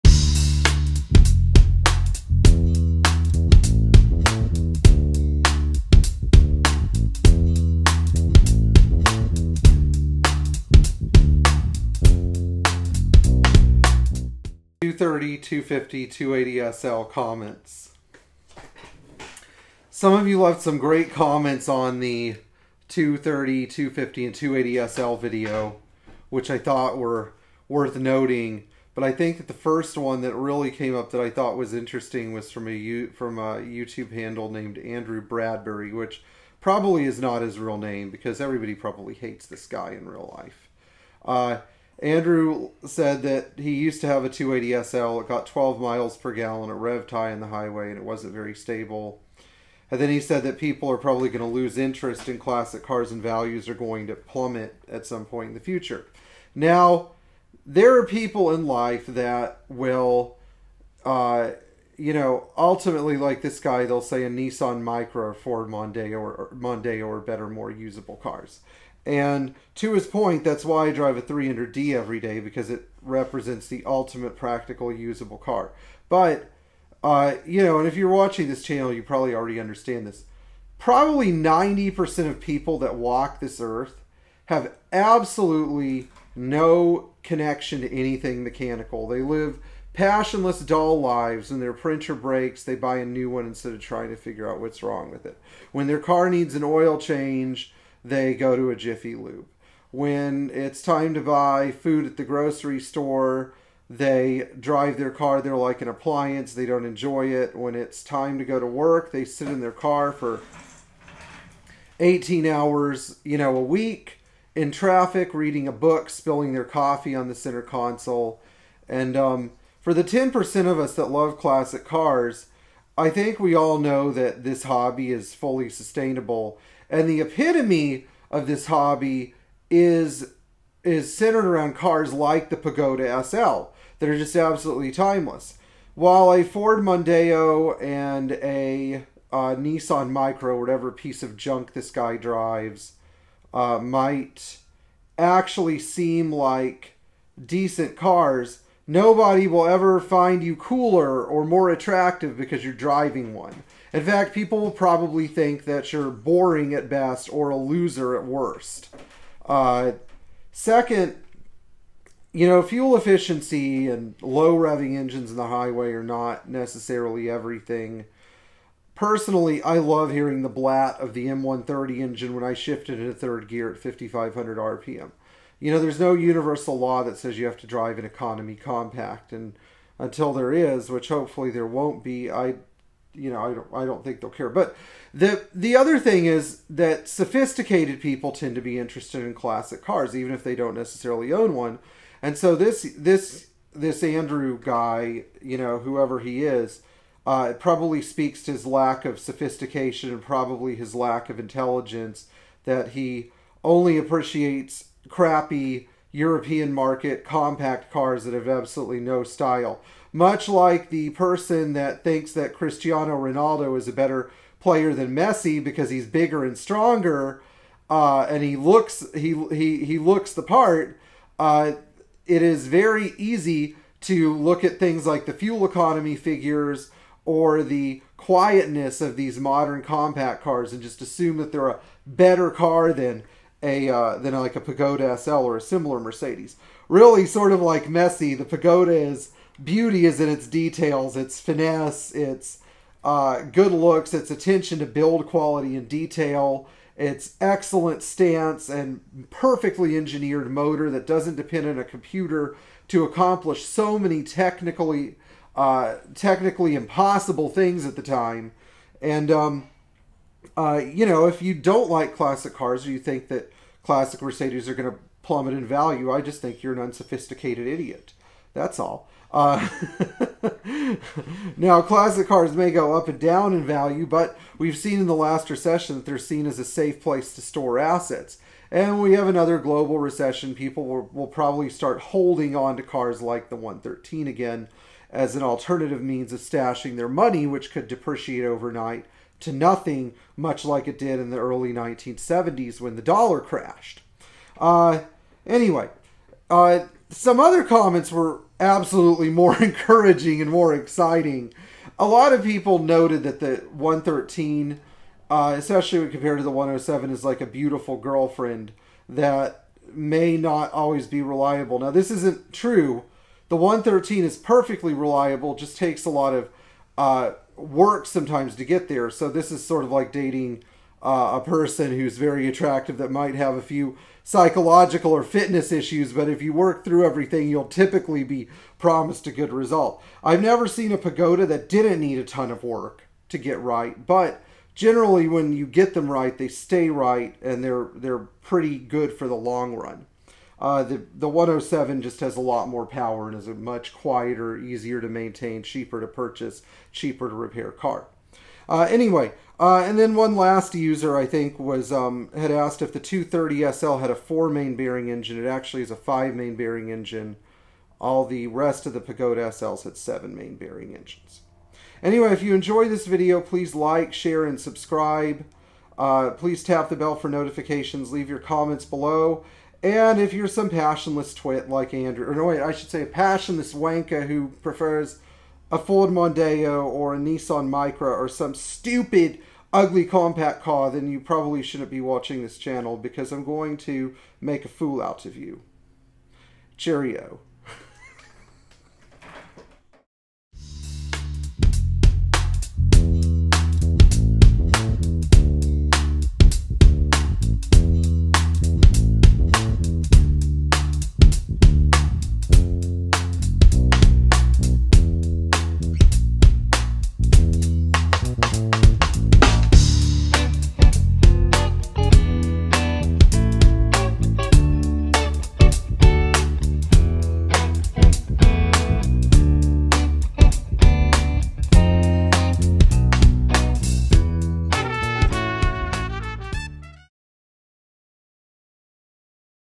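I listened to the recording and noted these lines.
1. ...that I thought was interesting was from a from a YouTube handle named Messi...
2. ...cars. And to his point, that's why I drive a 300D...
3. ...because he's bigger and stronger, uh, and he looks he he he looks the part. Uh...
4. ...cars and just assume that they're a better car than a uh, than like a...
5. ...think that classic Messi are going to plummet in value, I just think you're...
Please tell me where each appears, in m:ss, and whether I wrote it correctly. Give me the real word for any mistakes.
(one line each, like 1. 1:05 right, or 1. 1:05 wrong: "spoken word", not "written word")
1. 0:31 wrong: "Andrew", not "Messi"
2. 1:08 right
3. 3:35 right
4. 3:50 right
5. 4:22 wrong: "Mercedes", not "Messi".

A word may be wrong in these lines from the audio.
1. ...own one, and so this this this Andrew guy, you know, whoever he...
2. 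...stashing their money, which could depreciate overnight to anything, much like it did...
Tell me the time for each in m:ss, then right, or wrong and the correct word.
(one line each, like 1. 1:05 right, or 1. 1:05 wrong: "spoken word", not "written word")
1. 3:11 right
2. 4:46 wrong: "nothing", not "anything".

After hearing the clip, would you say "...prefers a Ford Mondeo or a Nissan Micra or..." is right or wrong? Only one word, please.
right.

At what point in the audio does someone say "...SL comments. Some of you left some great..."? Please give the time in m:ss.
0:16.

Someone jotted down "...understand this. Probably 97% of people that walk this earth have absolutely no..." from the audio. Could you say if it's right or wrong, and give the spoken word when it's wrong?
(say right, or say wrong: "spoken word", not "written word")
wrong: "90", not "97".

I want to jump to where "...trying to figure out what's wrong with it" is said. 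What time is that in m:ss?
1:33.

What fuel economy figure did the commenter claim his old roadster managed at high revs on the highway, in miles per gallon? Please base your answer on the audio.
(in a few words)
12.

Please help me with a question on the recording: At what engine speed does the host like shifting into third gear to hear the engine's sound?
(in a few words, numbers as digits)
5,500 RPM.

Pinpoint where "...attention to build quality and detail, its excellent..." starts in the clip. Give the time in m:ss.
4:04.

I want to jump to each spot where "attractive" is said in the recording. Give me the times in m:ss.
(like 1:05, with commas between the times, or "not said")
2:31, 5:22.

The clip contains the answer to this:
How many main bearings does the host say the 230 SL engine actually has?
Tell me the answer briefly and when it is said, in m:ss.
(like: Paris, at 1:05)
5, at 5:55.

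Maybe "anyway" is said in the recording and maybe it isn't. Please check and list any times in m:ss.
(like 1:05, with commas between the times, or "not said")
4:55, 5:48, 6:02.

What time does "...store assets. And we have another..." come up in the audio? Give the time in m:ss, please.
4:37.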